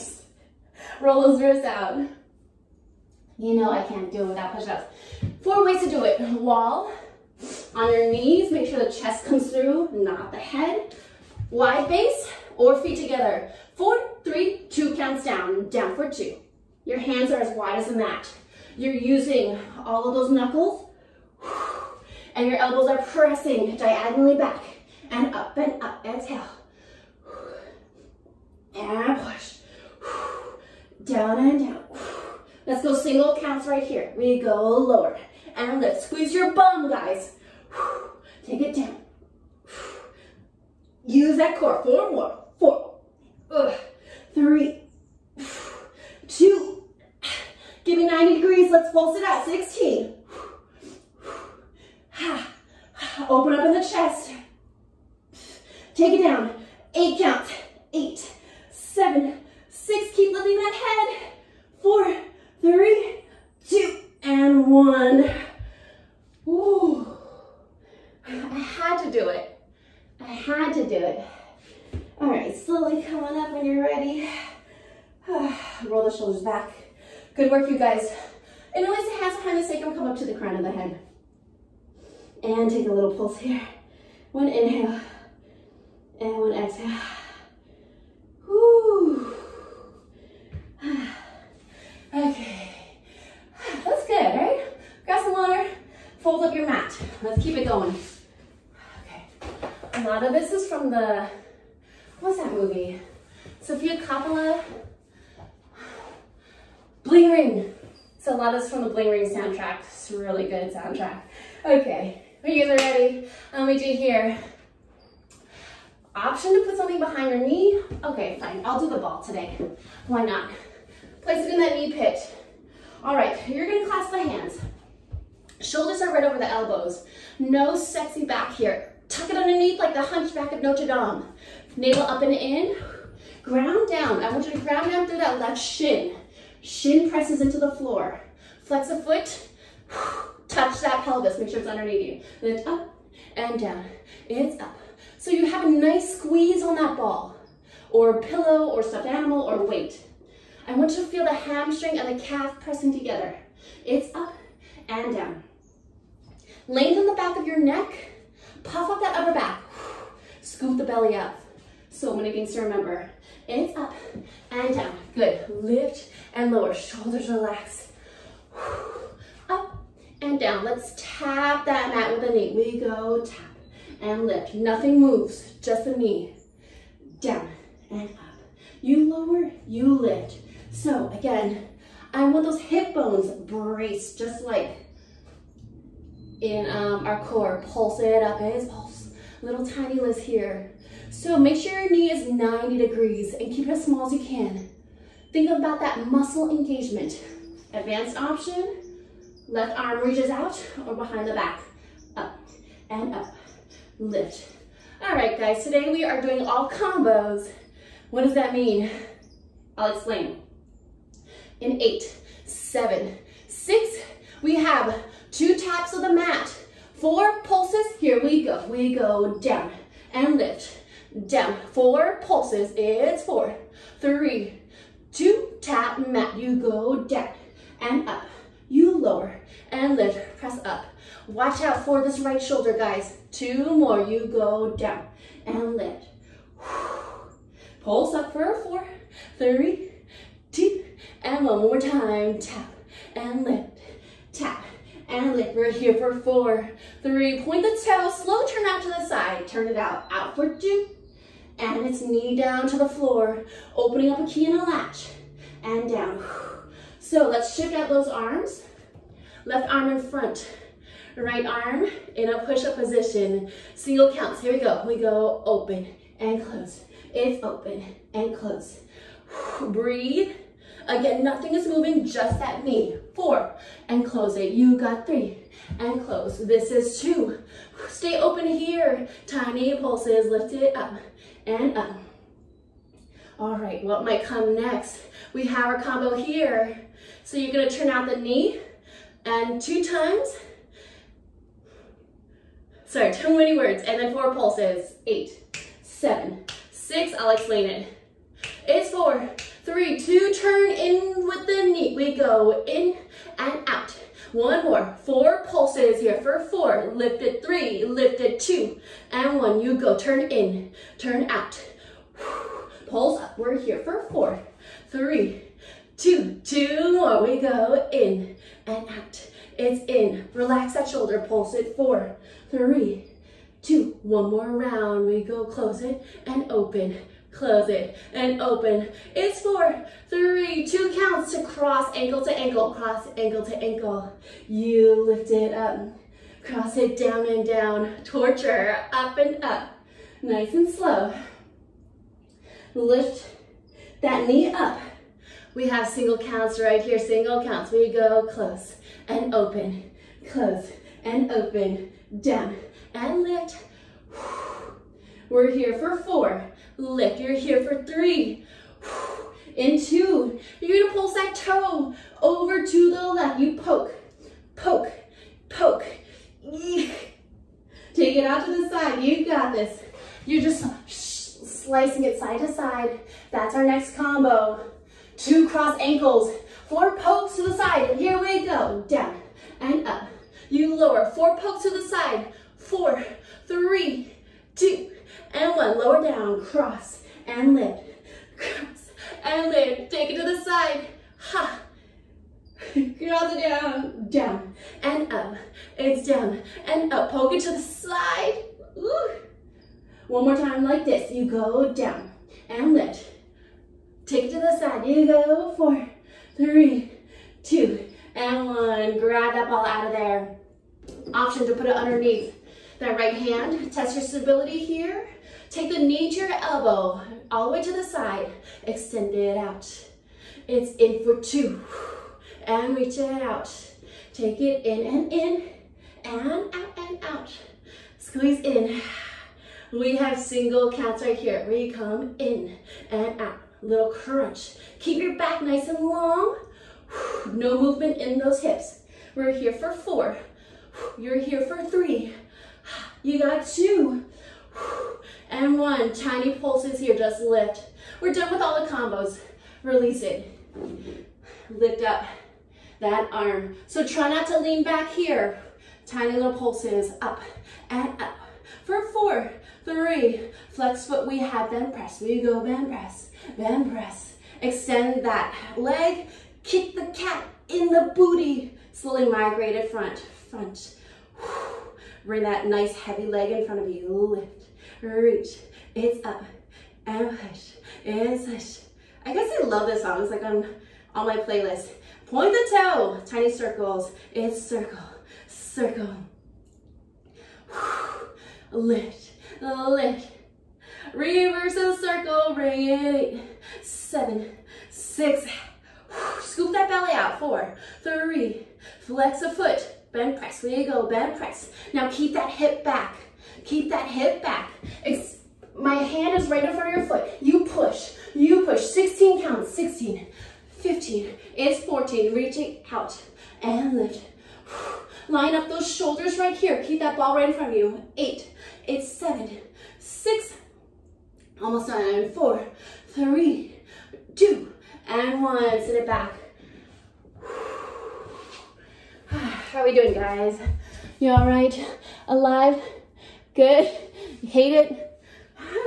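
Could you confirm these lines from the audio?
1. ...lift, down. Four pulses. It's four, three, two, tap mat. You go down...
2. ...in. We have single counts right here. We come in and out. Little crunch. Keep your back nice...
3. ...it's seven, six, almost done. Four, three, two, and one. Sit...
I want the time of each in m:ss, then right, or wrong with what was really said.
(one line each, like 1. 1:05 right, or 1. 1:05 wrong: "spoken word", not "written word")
1. 3:40 right
2. 7:08 right
3. 8:38 right.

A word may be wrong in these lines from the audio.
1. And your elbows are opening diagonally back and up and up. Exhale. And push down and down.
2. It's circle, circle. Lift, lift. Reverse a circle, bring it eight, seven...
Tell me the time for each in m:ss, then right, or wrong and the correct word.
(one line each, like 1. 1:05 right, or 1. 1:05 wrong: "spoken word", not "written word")
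1. 0:22 wrong: "pressing", not "opening"
2. 8:04 right.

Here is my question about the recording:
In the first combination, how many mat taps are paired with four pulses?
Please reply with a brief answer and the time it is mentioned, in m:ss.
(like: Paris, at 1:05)
2, at 3:35.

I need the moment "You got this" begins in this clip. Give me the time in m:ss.
6:09.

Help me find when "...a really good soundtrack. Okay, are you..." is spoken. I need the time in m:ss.
1:50.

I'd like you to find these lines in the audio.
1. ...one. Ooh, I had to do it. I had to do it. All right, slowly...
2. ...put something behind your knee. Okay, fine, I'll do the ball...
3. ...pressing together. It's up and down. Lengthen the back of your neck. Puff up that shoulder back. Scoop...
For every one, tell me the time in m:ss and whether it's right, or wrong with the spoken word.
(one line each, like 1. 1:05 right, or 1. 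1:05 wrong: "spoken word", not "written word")
1. 1:04 right
2. 1:56 right
3. 2:32 wrong: "upper", not "shoulder".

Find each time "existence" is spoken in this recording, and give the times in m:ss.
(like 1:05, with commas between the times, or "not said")
not said.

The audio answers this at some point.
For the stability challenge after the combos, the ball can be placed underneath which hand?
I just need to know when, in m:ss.
6:52.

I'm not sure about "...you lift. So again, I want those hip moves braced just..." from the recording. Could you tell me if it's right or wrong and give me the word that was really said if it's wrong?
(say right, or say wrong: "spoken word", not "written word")
wrong: "bones", not "moves".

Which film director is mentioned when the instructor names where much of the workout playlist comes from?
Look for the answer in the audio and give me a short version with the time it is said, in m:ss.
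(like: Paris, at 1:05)
Sofia Coppola, at 1:43.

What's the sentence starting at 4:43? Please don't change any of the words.
All right, what might come next?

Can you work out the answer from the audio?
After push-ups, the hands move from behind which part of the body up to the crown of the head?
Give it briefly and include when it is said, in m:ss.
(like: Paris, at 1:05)
Sacrum, at 1:19.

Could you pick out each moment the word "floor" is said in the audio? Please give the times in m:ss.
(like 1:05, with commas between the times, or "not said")
2:17, 4:12.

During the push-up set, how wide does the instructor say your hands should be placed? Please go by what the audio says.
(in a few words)
As wide as a mat.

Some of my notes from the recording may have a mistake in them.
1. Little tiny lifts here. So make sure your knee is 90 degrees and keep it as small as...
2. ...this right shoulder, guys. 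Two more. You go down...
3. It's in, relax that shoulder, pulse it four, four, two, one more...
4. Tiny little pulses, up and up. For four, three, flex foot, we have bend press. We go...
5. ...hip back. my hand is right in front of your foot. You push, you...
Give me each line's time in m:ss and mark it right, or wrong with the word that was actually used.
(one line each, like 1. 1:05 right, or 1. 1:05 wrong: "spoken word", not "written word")
1. 3:09 right
2. 3:52 right
3. 5:19 wrong: "three", not "four"
4. 7:35 right
5. 8:23 right.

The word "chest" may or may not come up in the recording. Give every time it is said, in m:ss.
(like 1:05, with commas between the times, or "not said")
0:08, 0:53.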